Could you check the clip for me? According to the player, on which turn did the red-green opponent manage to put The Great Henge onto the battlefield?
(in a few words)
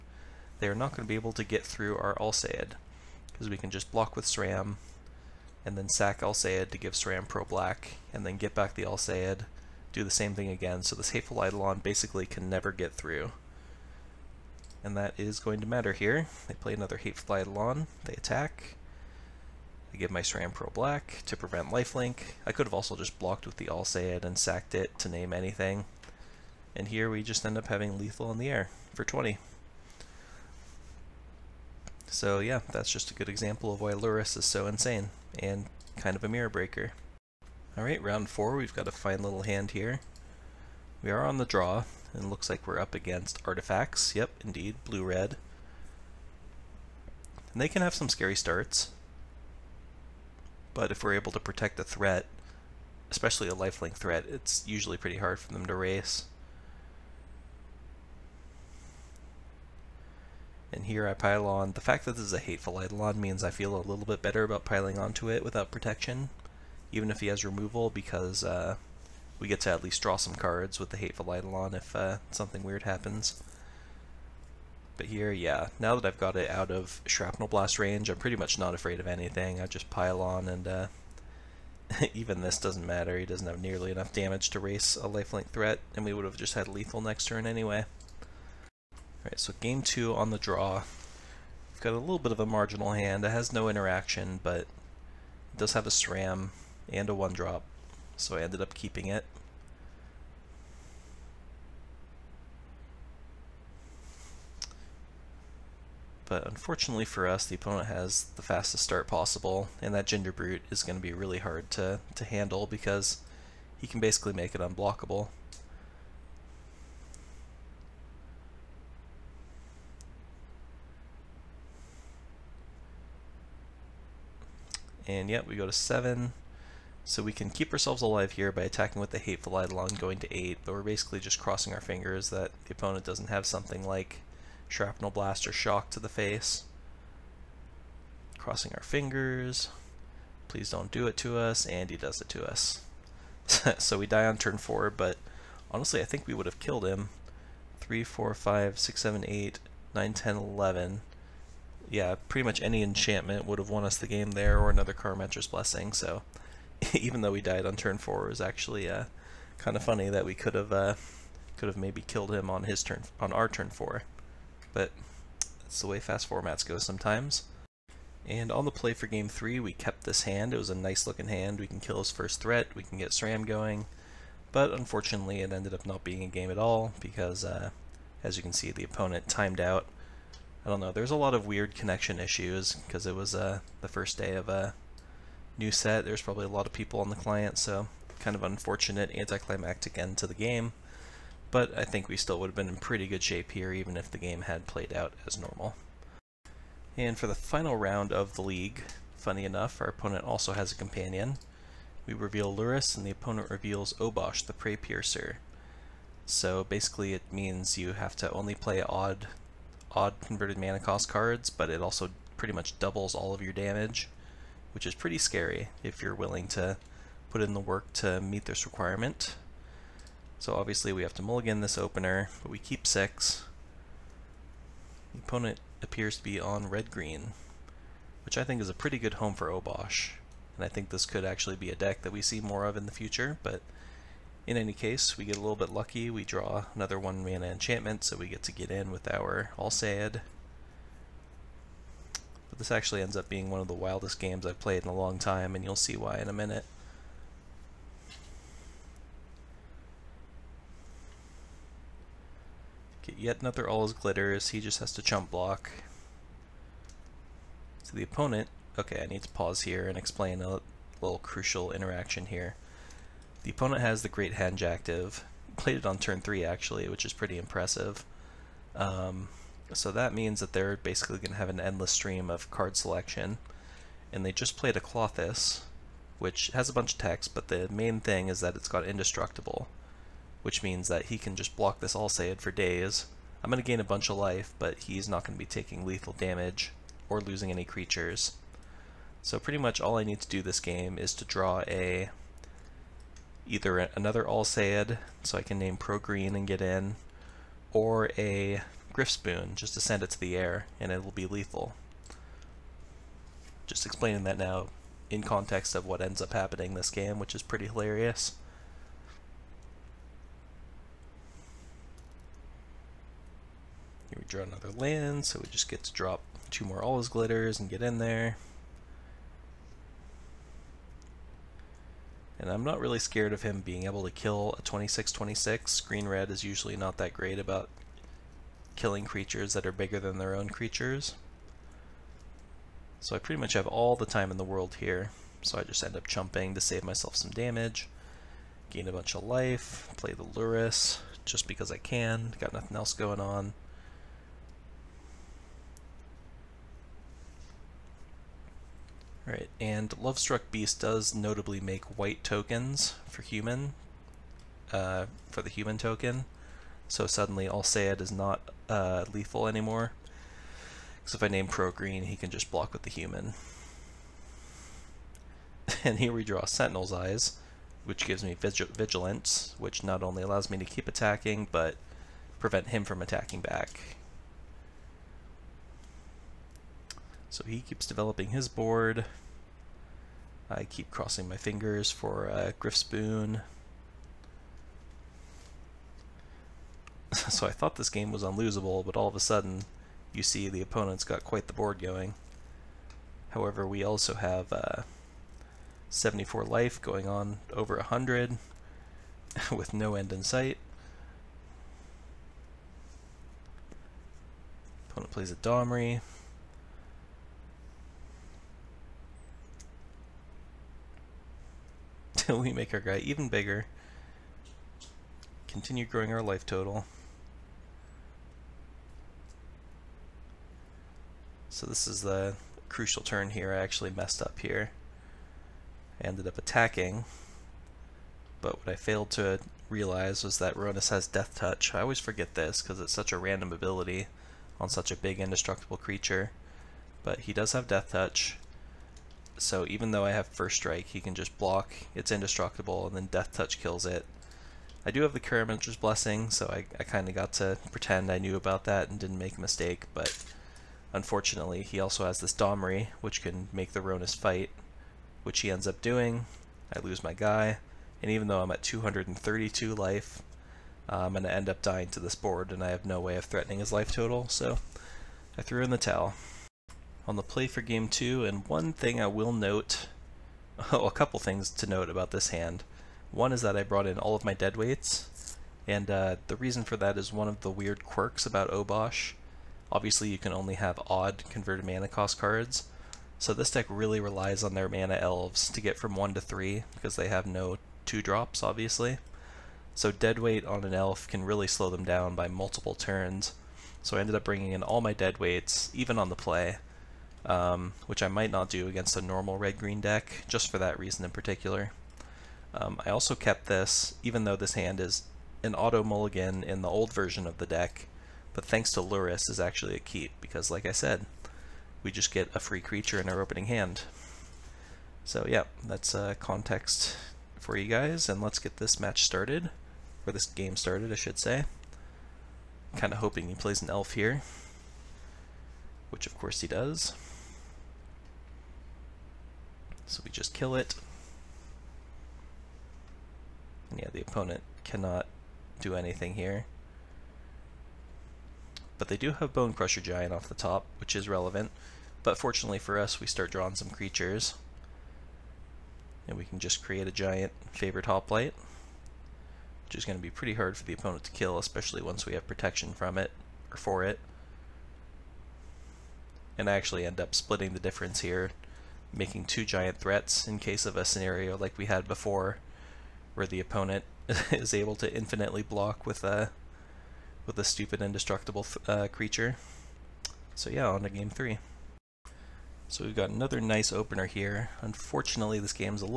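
Turn 3.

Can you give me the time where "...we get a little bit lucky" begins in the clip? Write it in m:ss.
3:55.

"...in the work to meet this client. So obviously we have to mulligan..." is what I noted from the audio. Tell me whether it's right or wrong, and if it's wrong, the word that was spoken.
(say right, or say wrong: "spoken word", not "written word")
wrong: "requirement", not "client".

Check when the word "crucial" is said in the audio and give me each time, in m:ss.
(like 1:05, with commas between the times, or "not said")
4:21, 7:02.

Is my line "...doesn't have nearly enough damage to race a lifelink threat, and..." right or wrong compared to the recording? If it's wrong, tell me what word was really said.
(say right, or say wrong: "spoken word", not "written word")
right.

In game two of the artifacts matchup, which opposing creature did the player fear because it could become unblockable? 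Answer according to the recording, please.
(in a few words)
Gingerbrute.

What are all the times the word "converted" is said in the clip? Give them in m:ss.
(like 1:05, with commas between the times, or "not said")
3:30, 8:01.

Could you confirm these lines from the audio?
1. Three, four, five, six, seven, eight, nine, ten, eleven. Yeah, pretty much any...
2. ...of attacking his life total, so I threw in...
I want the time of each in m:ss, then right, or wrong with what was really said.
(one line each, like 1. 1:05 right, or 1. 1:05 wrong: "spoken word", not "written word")
1. 2:27 right
2. 7:43 wrong: "threatening", not "attacking".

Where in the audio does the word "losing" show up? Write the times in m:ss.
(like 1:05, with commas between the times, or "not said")
4:47.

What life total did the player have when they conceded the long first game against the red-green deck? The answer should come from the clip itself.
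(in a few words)
232.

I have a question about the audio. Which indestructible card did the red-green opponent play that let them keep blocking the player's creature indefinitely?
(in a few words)
Klothys.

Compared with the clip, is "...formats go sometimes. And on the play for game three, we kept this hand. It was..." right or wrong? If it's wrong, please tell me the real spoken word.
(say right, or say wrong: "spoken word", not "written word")
right.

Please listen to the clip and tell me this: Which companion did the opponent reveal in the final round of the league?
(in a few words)
Obosh, the Preypiercer.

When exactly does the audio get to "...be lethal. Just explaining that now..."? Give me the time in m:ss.
5:01.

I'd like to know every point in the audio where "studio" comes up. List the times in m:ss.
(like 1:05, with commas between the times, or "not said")
not said.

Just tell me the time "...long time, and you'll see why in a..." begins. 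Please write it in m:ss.
4:04.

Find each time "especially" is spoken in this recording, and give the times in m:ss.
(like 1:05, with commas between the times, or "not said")
0:53, 9:11.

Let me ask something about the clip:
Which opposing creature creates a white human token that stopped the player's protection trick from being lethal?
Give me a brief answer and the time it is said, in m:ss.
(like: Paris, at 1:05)
Lovestruck Beast, at 5:49.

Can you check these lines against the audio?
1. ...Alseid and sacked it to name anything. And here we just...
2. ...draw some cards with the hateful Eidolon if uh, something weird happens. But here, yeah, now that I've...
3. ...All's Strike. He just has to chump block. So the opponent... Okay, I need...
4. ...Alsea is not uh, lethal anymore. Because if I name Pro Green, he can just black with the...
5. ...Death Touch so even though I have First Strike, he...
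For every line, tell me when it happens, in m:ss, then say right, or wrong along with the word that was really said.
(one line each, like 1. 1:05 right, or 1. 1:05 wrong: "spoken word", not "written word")
1. 0:23 right
2. 1:10 right
3. 4:13 wrong: "Glitters", not "Strike"
4. 5:57 wrong: "block", not "black"
5. 7:17 right.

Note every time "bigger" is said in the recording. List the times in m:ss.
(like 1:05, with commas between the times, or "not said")
5:29, 6:53.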